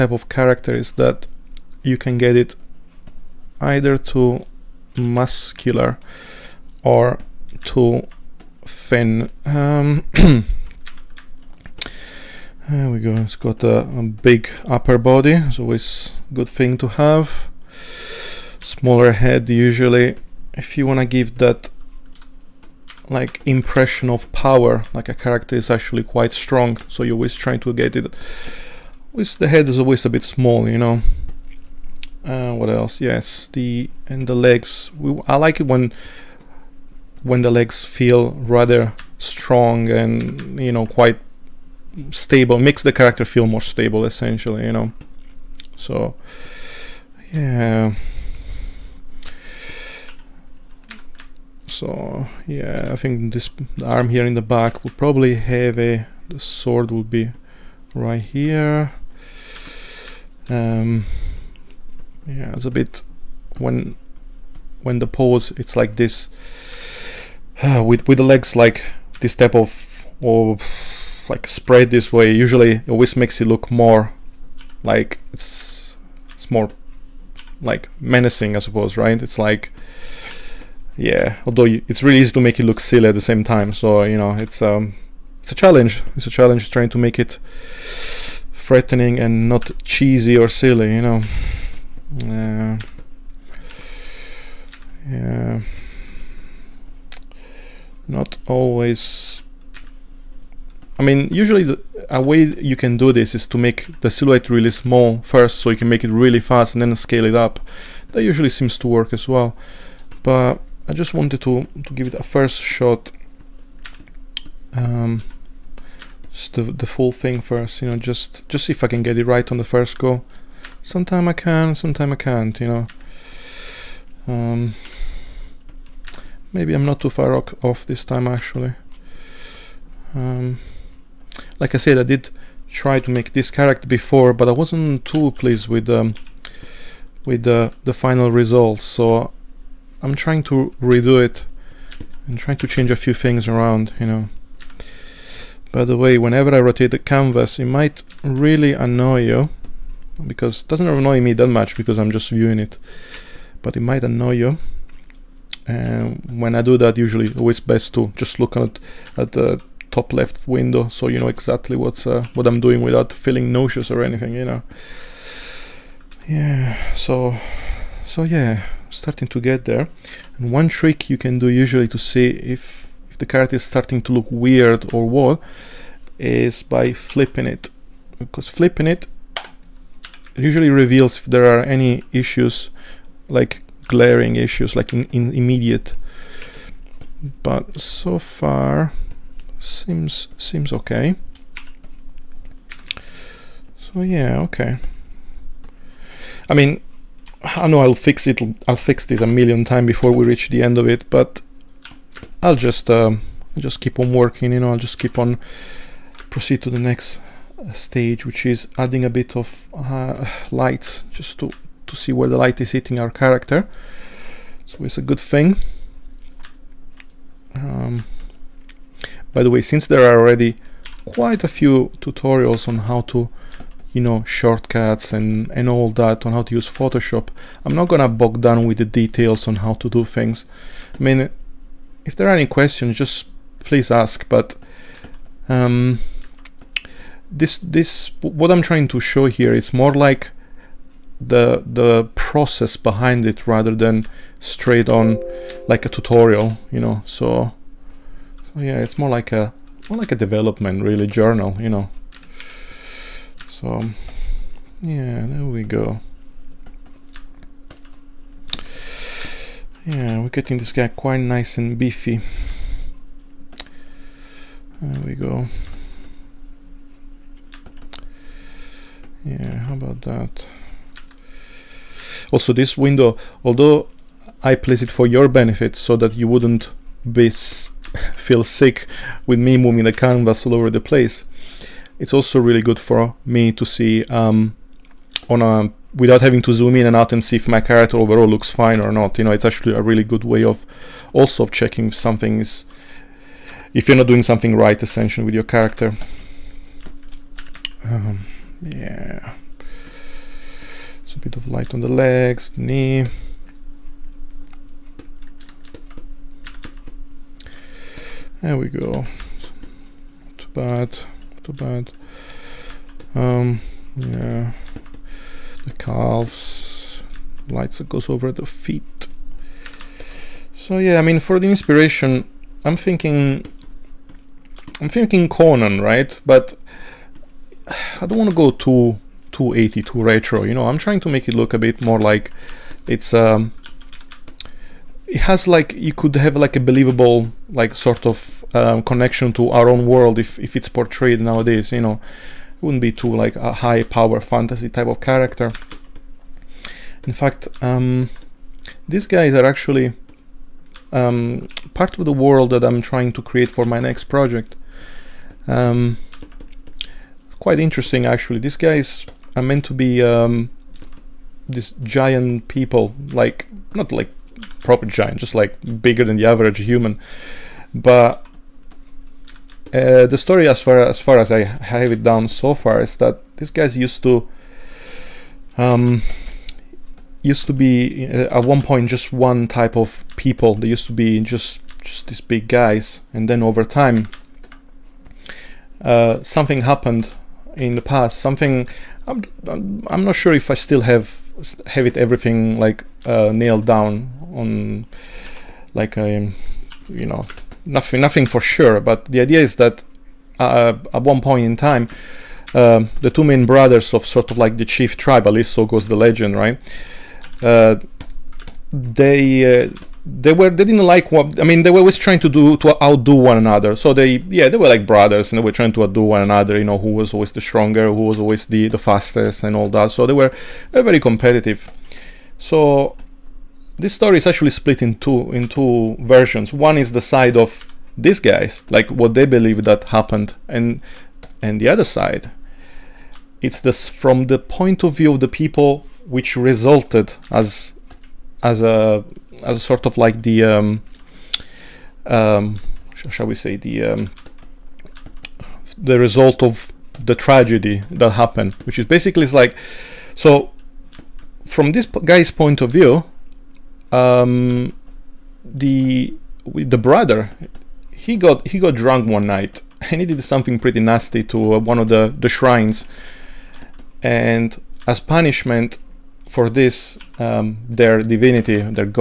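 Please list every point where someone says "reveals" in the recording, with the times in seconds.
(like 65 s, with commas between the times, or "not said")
180 s.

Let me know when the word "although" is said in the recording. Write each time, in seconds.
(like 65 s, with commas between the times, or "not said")
81 s, 273 s.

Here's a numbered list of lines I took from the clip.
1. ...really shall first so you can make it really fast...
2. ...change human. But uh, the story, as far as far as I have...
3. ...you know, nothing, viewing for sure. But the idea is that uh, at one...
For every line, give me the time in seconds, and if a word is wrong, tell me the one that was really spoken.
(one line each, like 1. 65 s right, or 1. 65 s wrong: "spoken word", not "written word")
1. 104 s wrong: "small", not "shall"
2. 366 s wrong: "average", not "change"
3. 396 s wrong: "nothing", not "viewing".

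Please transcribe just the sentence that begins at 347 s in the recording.
In fact, um, these guys are actually um, part of the world that I'm trying to create for my next project.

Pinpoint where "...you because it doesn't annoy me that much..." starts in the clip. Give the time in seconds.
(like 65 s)
149 s.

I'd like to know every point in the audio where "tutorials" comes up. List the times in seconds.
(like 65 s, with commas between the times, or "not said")
221 s, 245 s.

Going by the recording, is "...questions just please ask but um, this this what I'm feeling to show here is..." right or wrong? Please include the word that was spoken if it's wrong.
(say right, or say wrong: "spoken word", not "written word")
wrong: "trying", not "feeling".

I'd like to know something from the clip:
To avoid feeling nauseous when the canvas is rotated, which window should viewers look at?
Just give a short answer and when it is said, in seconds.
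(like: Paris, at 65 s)
Top left window, at 159 s.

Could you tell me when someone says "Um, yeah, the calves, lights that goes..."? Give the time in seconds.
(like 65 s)
313 s.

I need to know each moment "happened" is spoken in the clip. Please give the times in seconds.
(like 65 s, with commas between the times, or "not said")
386 s, 429 s, 448 s.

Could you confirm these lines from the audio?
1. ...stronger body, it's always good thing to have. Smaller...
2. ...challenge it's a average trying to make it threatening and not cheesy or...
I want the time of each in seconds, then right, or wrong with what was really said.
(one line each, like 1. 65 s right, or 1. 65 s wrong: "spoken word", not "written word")
1. 14 s wrong: "upper", not "stronger"
2. 85 s wrong: "challenge", not "average".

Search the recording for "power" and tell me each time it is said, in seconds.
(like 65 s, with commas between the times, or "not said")
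24 s, 343 s.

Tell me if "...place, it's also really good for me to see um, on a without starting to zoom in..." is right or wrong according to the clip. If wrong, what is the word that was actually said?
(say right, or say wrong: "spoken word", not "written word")
wrong: "having", not "starting".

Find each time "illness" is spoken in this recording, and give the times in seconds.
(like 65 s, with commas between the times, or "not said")
not said.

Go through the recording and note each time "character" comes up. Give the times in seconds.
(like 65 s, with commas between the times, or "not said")
0 s, 25 s, 42 s, 133 s, 213 s, 287 s, 295 s, 345 s.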